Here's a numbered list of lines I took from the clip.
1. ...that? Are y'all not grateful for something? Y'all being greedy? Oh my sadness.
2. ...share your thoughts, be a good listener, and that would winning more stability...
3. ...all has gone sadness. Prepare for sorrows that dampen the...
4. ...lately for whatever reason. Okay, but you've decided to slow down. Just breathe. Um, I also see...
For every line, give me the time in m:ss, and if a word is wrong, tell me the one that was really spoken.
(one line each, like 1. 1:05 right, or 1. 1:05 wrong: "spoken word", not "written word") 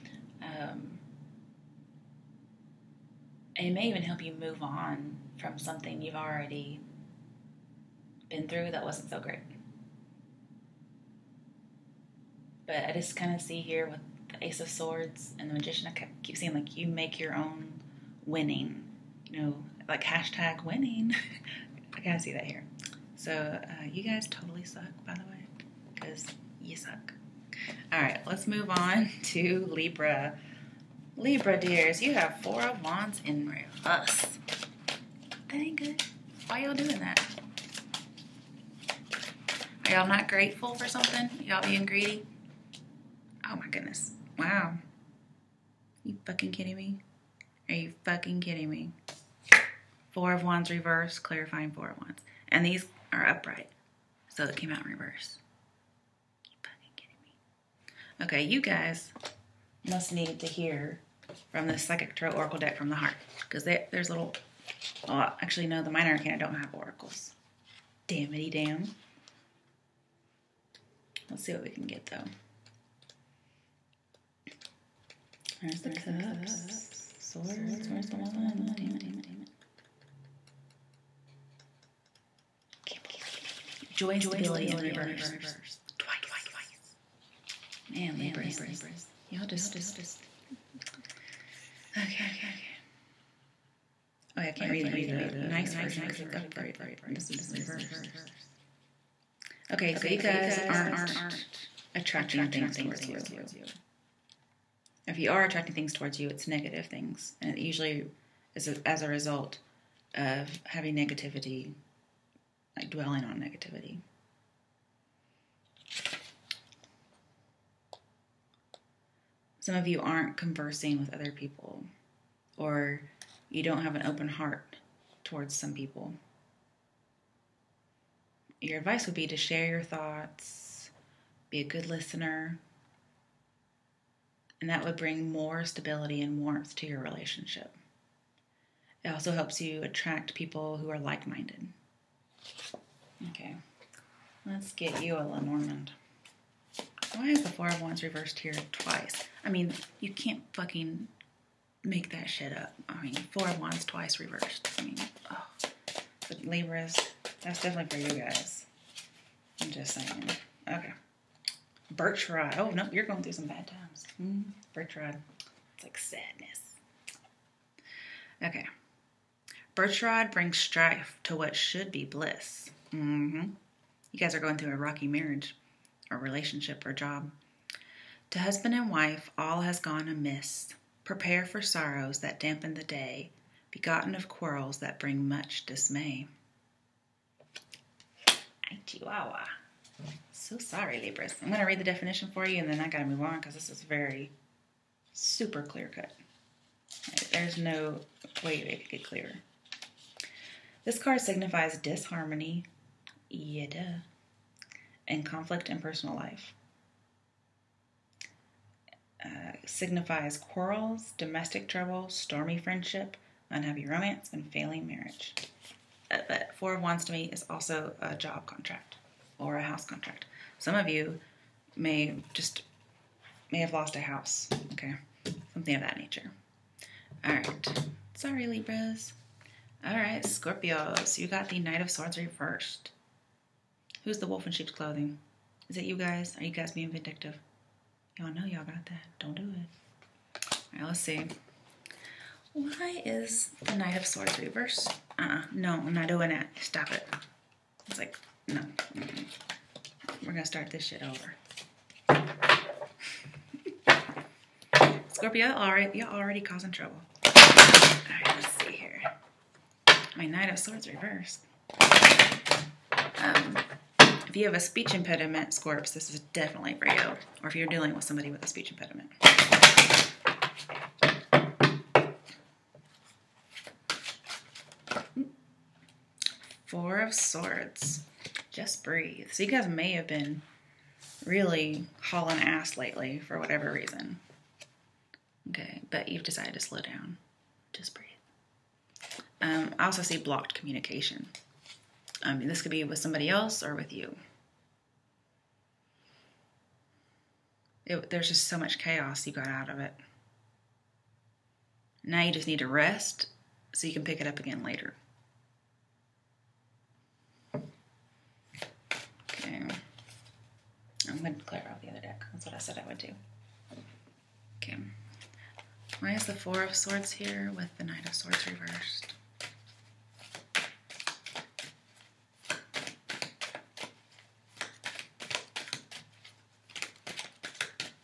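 1. 0:37 wrong: "goodness", not "sadness"
2. 2:09 wrong: "bring", not "winning"
3. 2:59 wrong: "amiss", not "sadness"
4. 4:42 right.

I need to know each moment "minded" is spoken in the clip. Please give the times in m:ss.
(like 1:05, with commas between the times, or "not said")
2:21.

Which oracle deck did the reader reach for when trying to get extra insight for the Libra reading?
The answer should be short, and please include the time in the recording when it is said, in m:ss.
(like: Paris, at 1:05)
Psychic Tarot Oracle, at 1:01.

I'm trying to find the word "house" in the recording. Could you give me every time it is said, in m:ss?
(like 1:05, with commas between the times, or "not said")
3:39, 3:44.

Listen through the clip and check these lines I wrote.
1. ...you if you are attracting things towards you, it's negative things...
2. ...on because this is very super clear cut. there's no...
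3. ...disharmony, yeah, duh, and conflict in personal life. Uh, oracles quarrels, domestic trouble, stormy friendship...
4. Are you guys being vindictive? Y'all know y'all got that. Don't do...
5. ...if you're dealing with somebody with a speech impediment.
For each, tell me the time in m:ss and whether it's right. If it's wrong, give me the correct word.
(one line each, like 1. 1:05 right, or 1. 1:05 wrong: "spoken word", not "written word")
1. 1:43 right
2. 3:13 right
3. 3:21 wrong: "signifies", not "oracles"
4. 3:56 right
5. 4:27 right.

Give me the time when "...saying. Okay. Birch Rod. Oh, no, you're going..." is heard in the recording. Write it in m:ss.
2:39.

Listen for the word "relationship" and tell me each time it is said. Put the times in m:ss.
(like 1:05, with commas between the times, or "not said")
2:17, 2:56.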